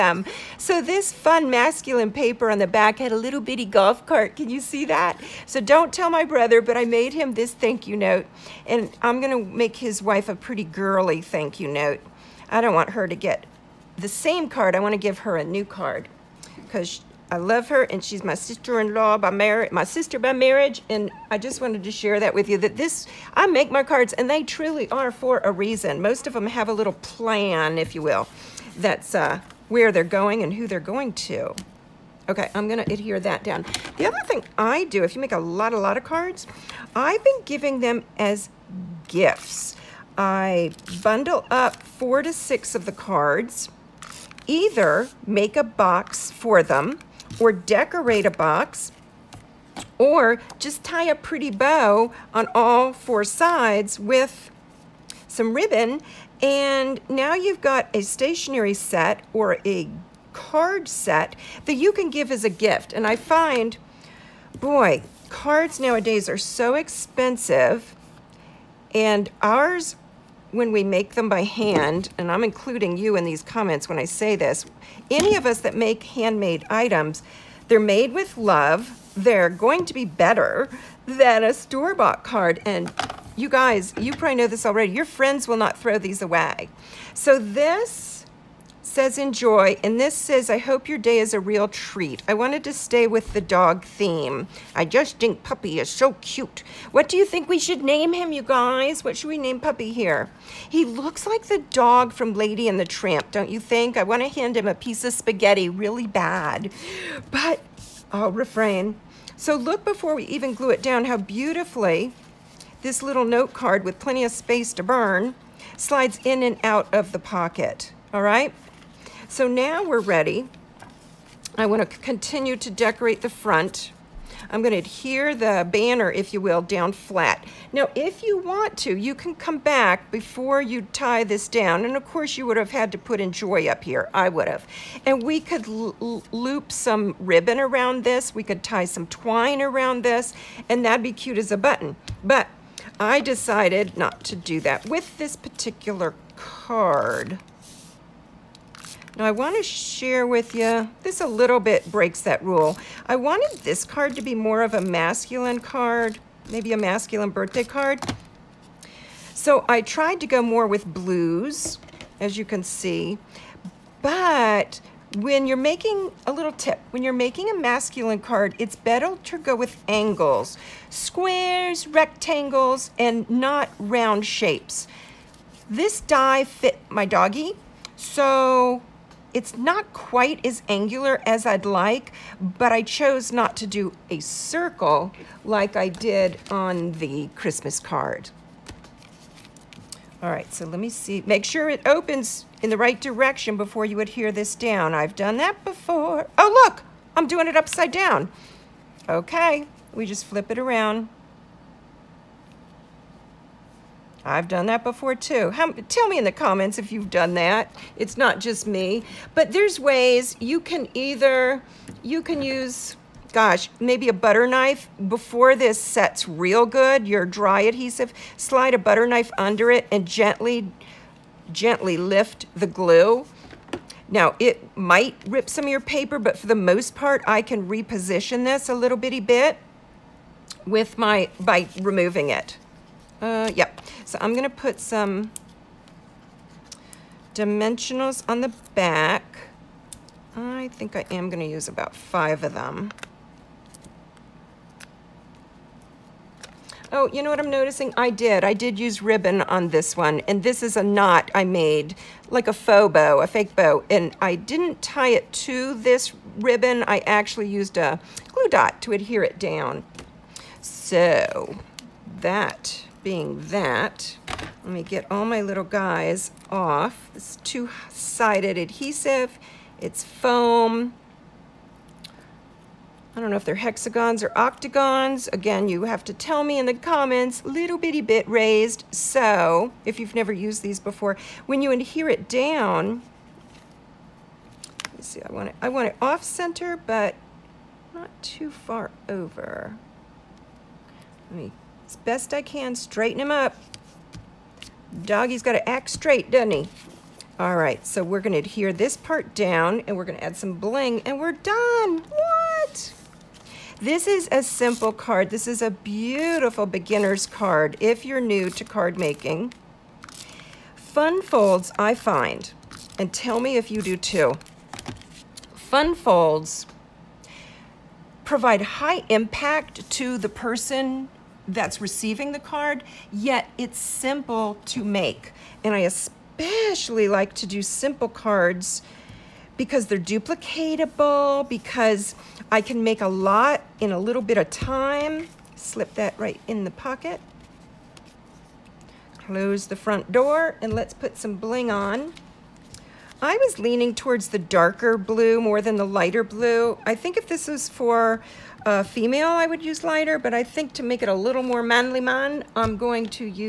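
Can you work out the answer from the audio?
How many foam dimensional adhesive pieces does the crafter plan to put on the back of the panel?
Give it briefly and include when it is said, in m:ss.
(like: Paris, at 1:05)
5, at 4:01.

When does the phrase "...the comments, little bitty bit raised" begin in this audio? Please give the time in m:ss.
4:36.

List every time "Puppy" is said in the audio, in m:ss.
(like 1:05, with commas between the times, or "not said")
1:35, 1:39.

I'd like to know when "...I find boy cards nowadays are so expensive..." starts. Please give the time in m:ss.
1:03.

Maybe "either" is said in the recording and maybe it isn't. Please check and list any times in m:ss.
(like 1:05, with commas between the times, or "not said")
0:44, 3:30.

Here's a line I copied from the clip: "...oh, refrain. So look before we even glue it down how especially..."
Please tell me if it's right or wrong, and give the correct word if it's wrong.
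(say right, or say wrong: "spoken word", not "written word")
wrong: "beautifully", not "especially".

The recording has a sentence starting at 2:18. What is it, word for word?
We could tie some twine around this.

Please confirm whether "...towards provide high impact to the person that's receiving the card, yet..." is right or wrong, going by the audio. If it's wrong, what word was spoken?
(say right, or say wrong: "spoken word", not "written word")
wrong: "folds", not "towards".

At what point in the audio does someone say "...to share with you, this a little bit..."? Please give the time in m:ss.
2:29.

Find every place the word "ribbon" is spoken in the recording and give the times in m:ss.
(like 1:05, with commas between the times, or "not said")
0:55, 2:17, 4:09, 4:16.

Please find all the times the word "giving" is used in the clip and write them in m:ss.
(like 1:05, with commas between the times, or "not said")
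0:37.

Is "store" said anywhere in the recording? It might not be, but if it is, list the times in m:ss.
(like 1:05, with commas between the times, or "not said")
1:21.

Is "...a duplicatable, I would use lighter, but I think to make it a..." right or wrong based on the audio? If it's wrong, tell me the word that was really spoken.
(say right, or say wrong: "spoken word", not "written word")
wrong: "female", not "duplicatable".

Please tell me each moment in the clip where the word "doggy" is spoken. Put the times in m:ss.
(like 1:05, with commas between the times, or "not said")
2:57, 4:55.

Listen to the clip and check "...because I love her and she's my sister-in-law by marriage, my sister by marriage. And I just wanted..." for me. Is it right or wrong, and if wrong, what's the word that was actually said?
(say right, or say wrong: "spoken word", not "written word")
right.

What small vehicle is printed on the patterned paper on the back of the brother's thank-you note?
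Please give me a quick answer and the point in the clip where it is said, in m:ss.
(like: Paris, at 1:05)
golf cart, at 0:03.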